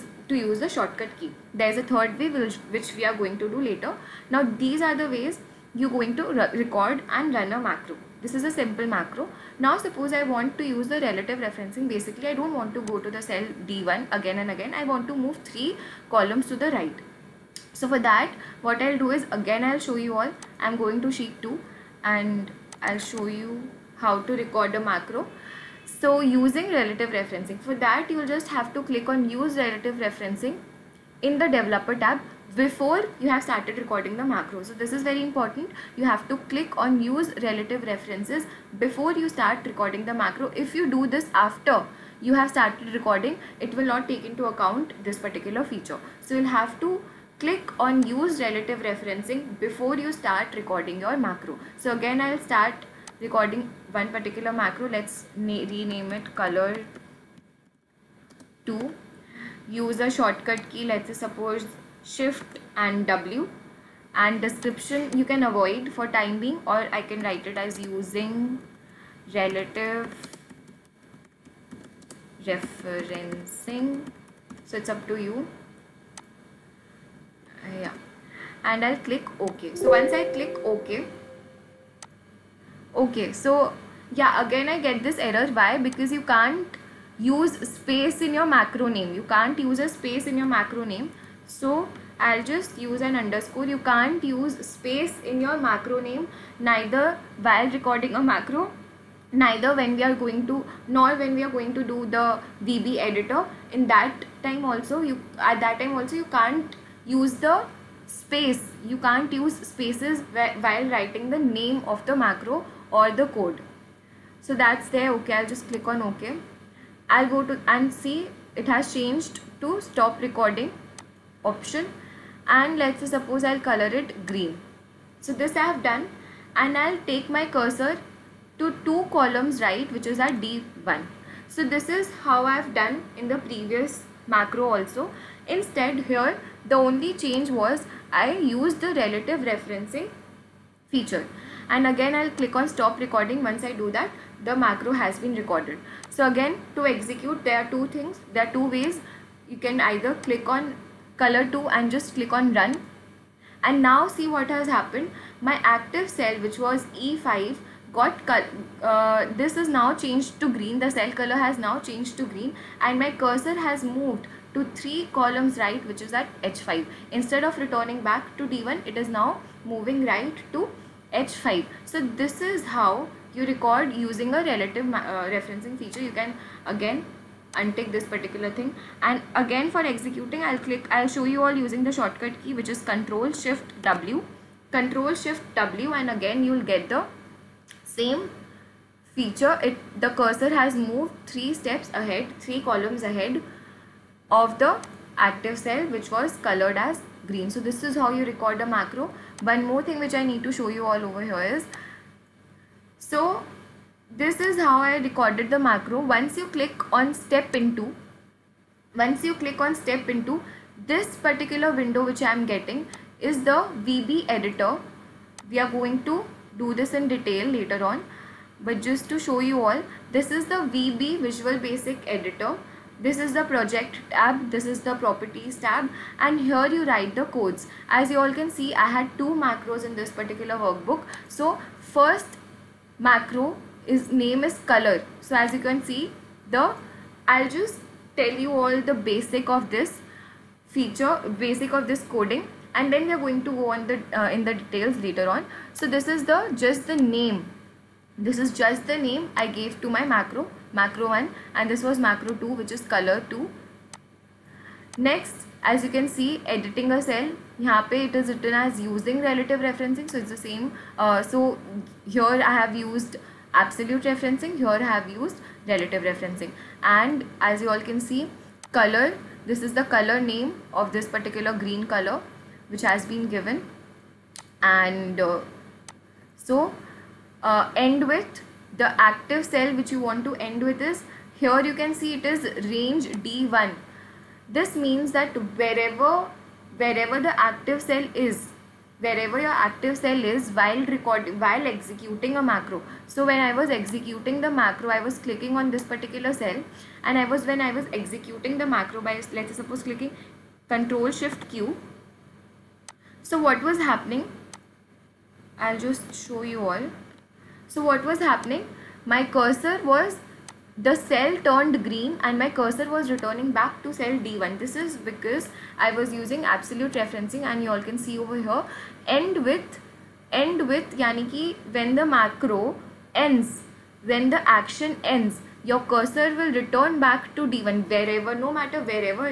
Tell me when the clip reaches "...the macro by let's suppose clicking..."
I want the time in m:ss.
4:58.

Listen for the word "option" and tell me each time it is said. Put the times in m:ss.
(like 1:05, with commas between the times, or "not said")
2:01.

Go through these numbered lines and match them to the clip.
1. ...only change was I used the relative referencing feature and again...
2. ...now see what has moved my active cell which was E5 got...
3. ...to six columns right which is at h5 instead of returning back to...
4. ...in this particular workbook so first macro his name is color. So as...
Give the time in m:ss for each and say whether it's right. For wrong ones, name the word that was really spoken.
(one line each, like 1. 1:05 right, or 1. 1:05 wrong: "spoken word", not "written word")
1. 2:16 right
2. 2:33 wrong: "happened", not "moved"
3. 2:44 wrong: "three", not "six"
4. 3:49 right.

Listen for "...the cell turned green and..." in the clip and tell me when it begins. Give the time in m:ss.
5:10.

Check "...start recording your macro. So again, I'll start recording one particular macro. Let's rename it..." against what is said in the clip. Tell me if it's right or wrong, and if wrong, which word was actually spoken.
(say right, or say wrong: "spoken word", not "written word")
right.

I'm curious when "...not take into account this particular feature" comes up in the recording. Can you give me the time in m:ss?
0:43.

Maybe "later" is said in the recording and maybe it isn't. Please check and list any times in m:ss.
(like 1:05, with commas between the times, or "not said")
0:03, 3:37, 4:04.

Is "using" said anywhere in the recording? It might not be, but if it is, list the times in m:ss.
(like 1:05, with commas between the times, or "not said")
0:26, 1:07, 2:53, 3:01, 4:18, 5:16.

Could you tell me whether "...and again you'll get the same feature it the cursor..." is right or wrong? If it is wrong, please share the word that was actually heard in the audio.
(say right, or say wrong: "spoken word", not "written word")
right.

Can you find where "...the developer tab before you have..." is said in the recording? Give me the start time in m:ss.
0:31.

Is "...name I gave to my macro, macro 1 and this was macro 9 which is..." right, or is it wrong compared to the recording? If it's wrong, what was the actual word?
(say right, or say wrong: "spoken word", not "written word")
wrong: "2", not "9".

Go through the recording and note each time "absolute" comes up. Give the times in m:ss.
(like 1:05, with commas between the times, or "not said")
4:23, 5:16.